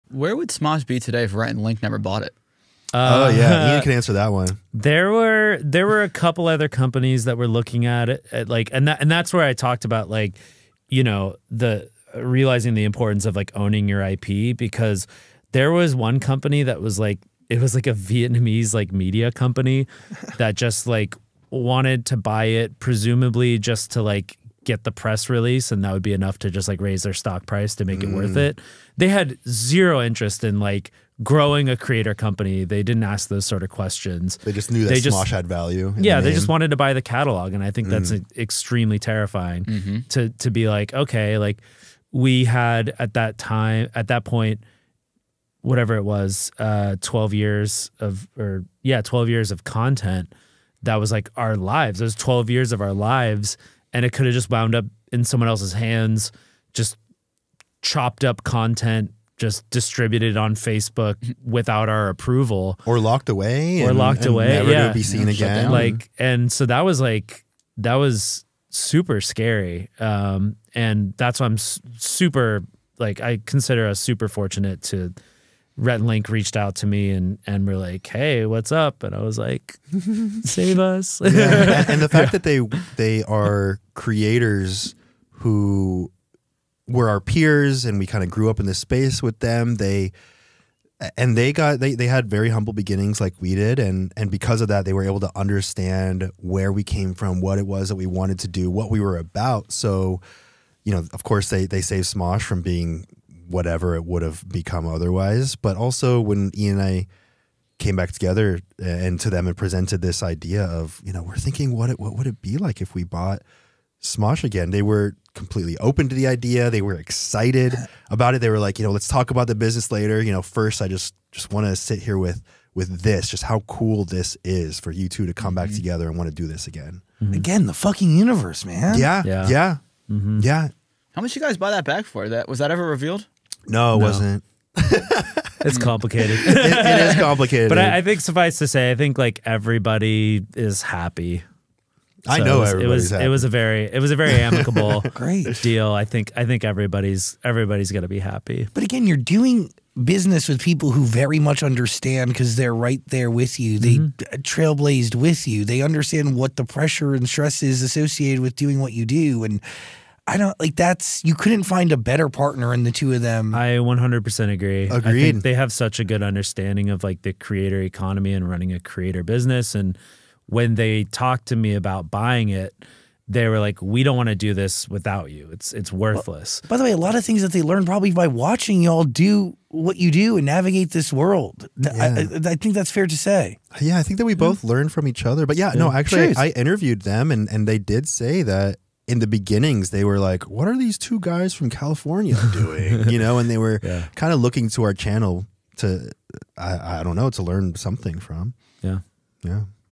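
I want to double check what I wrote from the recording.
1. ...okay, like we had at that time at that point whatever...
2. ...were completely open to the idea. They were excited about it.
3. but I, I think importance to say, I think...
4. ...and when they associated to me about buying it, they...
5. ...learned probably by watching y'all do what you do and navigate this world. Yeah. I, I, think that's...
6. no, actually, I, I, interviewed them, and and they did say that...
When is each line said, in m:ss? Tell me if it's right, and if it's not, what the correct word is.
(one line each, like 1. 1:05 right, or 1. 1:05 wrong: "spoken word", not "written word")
1. 0:40 right
2. 1:54 right
3. 2:17 wrong: "suffice", not "importance"
4. 2:49 wrong: "talked", not "associated"
5. 2:57 right
6. 3:05 right.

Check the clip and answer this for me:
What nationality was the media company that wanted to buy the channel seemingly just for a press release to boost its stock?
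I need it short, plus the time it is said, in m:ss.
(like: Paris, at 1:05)
Vietnamese, at 0:17.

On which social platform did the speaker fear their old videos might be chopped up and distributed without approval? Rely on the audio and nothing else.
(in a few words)
Facebook.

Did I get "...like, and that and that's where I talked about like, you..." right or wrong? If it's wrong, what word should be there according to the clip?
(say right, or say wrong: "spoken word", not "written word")
right.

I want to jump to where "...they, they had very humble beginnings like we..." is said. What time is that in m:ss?
1:31.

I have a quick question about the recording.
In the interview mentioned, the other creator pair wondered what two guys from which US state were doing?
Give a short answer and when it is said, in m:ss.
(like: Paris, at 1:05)
California, at 3:11.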